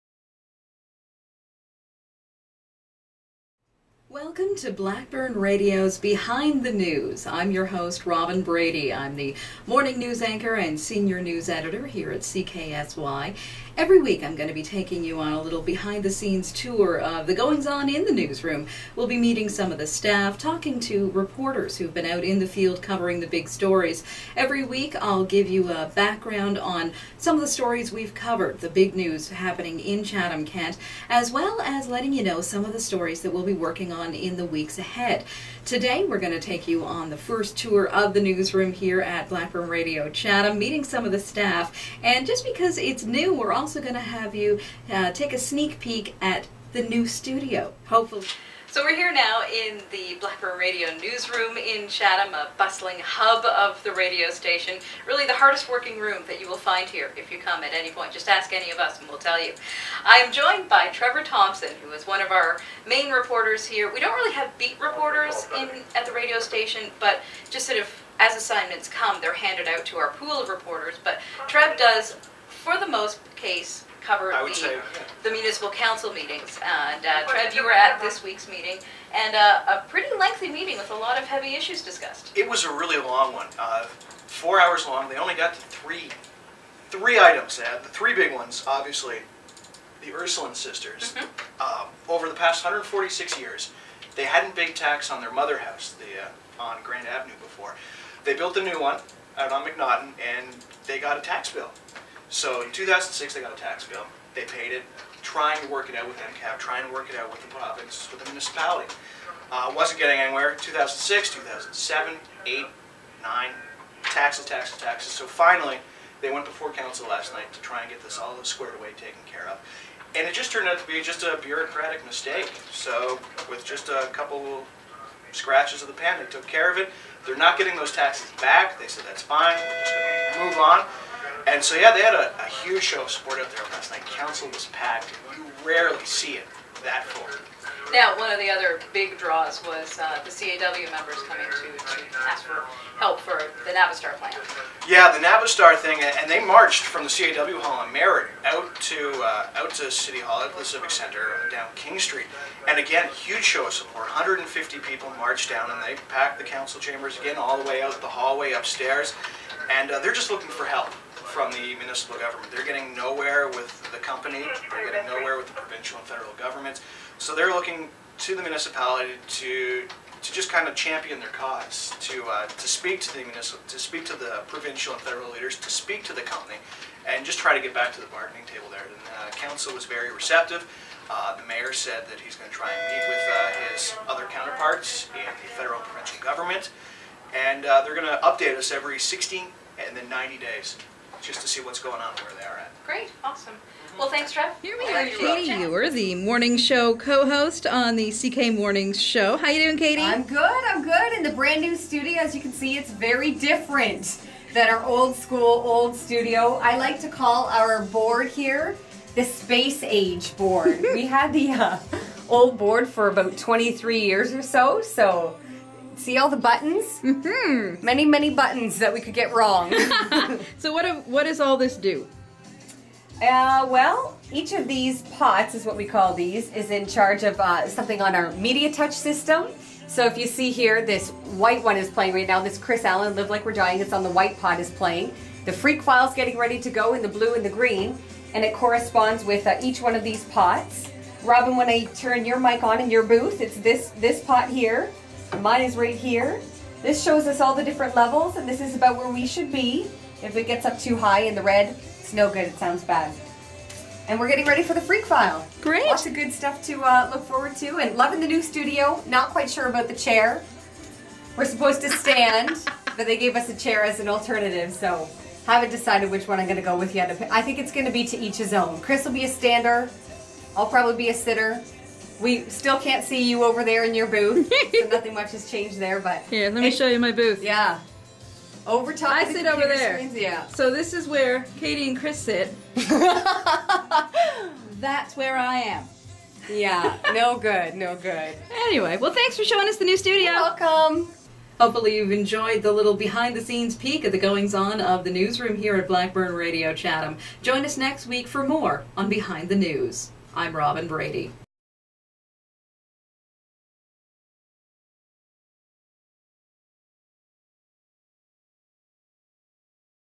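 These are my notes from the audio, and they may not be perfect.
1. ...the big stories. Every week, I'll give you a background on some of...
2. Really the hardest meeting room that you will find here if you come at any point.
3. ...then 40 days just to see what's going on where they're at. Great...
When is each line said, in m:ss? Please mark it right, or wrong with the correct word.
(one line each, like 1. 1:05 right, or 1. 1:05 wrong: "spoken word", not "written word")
1. 0:23 right
2. 0:55 wrong: "working", not "meeting"
3. 3:09 wrong: "90", not "40".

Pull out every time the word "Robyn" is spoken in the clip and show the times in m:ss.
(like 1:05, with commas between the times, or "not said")
0:08, 4:01, 5:00.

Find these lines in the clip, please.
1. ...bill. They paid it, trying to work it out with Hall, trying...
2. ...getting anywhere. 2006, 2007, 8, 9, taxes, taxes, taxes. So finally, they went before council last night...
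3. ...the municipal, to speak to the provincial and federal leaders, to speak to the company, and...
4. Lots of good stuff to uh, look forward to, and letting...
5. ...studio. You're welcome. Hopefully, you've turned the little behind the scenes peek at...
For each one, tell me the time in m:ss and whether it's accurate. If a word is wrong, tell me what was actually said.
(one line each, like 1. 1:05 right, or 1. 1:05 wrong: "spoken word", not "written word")
1. 1:43 wrong: "MPAC", not "Hall"
2. 1:49 right
3. 2:53 right
4. 4:15 wrong: "loving", not "letting"
5. 4:49 wrong: "enjoyed", not "turned".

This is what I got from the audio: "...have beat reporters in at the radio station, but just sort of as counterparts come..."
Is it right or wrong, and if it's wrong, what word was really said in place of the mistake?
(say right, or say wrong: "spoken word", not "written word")
wrong: "assignments", not "counterparts".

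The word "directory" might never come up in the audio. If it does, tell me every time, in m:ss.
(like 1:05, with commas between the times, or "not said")
not said.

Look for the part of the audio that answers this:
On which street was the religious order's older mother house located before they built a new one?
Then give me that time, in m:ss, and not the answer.
1:36.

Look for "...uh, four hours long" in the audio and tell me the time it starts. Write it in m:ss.
1:23.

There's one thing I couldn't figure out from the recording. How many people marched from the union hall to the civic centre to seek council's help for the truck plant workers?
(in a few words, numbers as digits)
150.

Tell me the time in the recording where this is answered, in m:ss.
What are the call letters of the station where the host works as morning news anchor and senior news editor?
0:12.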